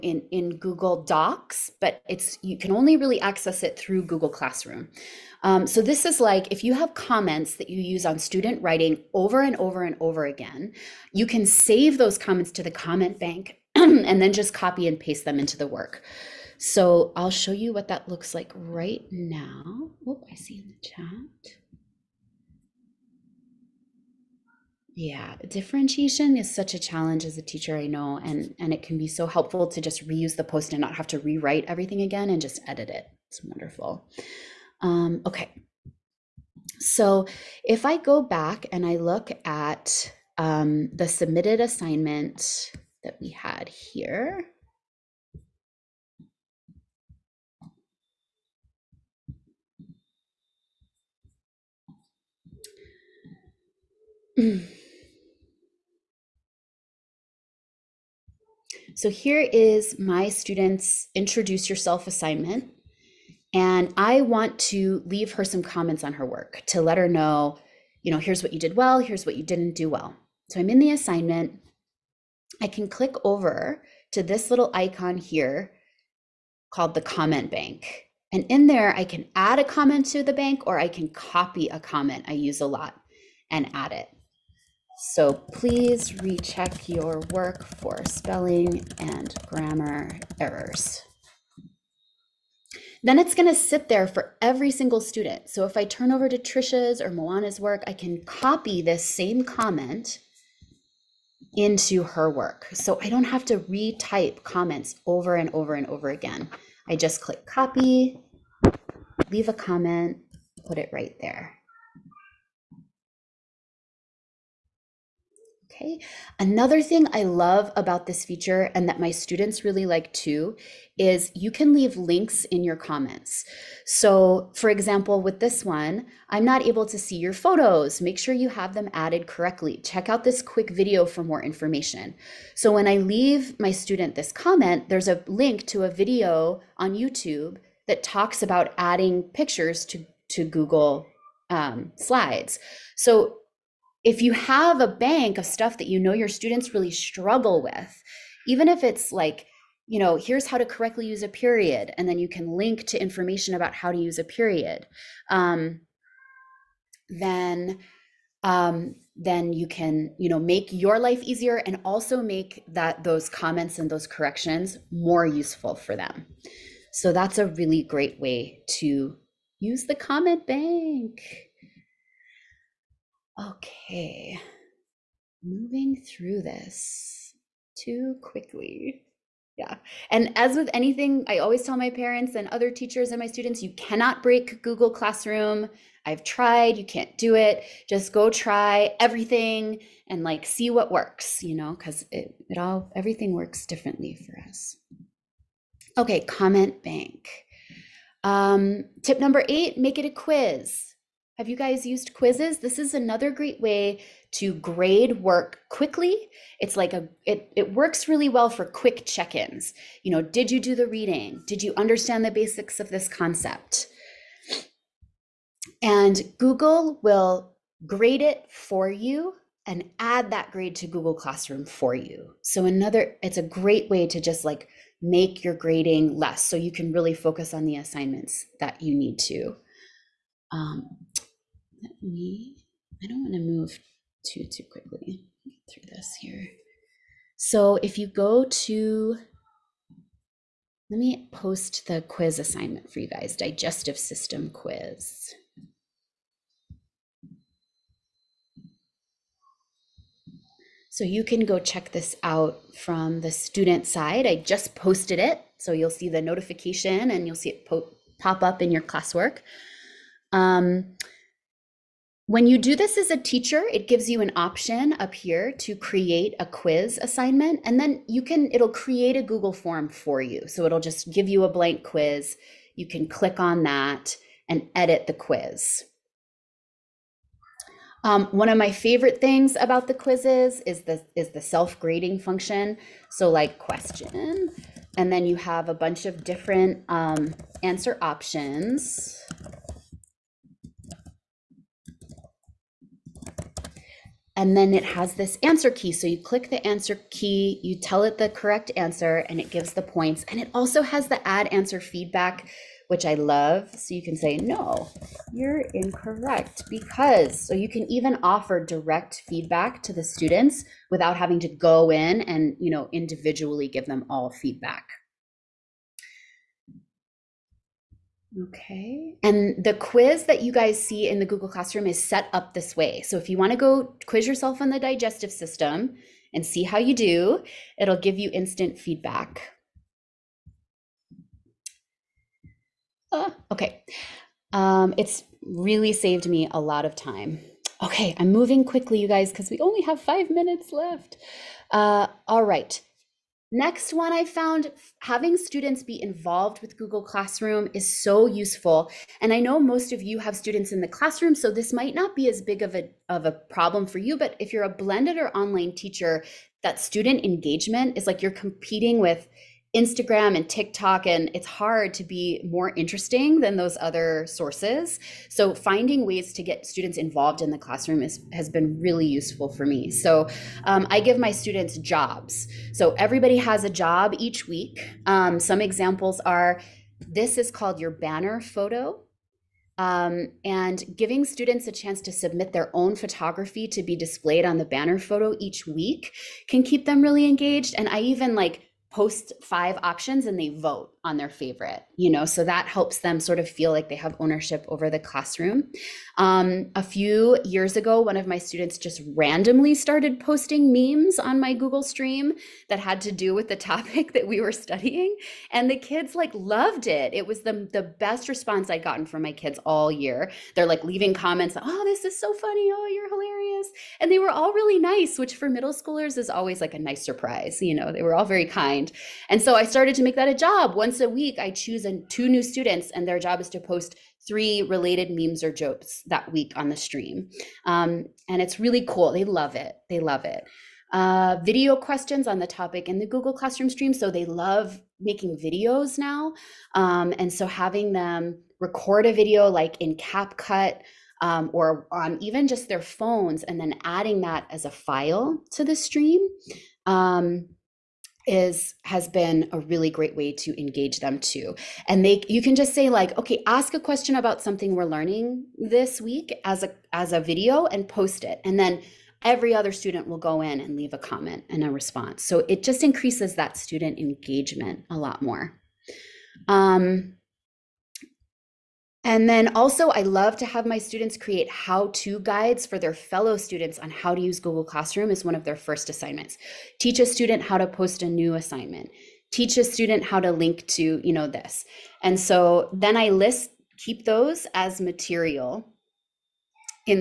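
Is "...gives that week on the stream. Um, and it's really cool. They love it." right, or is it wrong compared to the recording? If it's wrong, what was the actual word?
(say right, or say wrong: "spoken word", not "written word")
wrong: "jokes", not "gives".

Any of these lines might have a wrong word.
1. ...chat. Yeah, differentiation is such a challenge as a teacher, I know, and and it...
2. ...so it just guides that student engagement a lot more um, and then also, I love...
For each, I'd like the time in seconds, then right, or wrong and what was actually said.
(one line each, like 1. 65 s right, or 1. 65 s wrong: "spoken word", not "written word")
1. 20 s right
2. 462 s wrong: "increases", not "guides".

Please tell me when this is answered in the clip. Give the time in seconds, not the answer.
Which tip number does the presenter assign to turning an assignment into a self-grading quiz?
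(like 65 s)
199 s.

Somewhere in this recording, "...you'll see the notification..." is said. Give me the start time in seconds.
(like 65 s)
255 s.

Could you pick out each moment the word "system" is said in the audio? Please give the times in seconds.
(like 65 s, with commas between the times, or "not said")
243 s, 325 s.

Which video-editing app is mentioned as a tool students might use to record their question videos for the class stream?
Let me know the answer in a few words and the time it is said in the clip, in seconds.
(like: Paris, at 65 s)
CapCut, at 439 s.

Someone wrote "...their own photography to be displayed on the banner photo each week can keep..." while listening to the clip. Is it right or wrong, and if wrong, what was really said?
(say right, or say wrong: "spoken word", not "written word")
right.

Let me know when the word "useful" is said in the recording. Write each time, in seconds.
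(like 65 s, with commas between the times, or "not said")
165 s, 348 s, 369 s.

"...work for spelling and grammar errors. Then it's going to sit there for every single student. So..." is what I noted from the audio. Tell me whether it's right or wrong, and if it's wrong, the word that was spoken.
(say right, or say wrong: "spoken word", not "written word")
right.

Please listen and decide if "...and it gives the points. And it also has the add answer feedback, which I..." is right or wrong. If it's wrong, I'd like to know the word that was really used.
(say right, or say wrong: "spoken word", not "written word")
right.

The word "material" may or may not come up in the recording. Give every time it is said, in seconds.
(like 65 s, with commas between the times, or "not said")
484 s.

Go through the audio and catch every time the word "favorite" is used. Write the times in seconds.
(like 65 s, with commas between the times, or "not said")
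278 s, 391 s.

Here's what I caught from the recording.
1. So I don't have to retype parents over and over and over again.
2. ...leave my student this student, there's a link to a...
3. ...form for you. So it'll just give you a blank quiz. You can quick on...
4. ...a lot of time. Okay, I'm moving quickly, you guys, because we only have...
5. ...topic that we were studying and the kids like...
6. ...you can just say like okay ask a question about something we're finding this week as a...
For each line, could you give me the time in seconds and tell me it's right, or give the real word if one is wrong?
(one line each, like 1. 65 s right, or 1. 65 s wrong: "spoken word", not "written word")
1. 102 s wrong: "comments", not "parents"
2. 132 s wrong: "comment", not "student"
3. 269 s wrong: "click", not "quick"
4. 336 s right
5. 403 s right
6. 452 s wrong: "learning", not "finding".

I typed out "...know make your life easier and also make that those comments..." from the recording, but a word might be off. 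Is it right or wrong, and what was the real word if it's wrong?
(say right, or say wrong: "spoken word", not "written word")
right.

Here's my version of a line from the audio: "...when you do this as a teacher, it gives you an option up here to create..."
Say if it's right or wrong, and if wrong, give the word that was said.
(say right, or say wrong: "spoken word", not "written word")
right.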